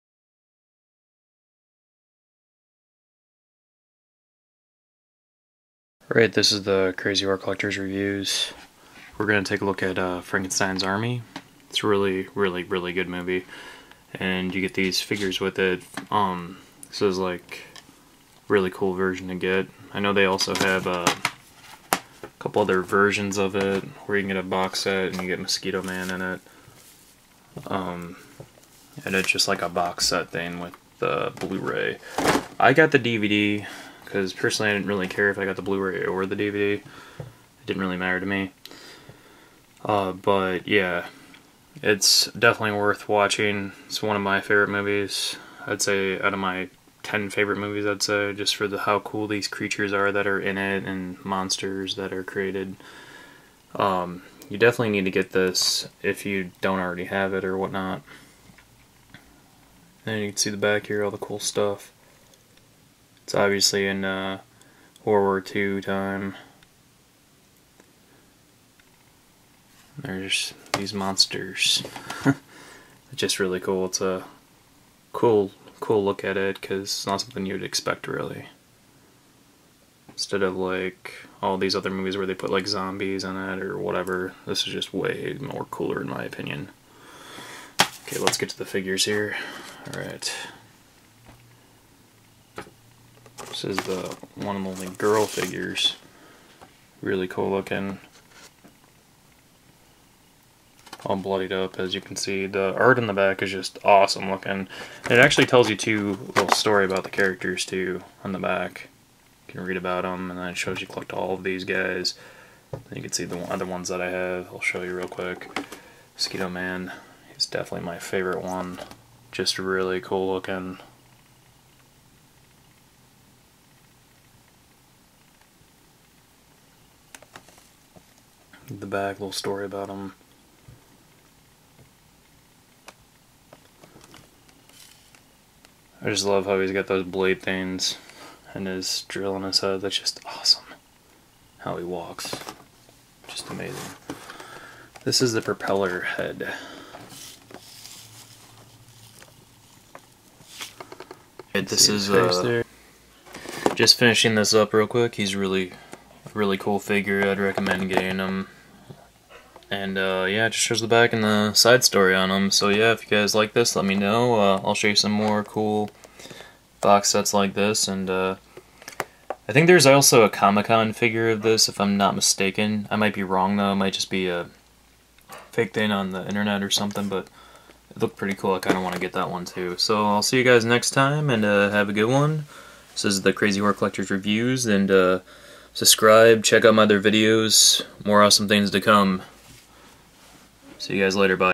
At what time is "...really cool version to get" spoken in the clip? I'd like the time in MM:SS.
00:18.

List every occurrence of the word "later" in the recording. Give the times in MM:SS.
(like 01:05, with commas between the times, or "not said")
03:11.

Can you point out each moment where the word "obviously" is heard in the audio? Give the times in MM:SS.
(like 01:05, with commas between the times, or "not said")
01:03.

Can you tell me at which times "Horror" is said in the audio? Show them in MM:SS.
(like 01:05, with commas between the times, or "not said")
00:07, 03:03.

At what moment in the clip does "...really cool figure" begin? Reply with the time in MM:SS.
02:36.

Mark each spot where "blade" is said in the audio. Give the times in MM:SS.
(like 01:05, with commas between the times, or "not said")
02:17.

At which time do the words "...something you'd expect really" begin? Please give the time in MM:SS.
01:17.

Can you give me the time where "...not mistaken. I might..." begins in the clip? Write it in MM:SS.
02:51.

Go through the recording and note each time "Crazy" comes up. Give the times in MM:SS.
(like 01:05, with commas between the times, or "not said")
00:06, 03:03.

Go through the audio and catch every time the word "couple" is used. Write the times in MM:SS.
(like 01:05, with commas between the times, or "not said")
00:22.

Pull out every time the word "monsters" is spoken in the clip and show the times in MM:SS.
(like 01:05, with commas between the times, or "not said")
00:51, 01:10.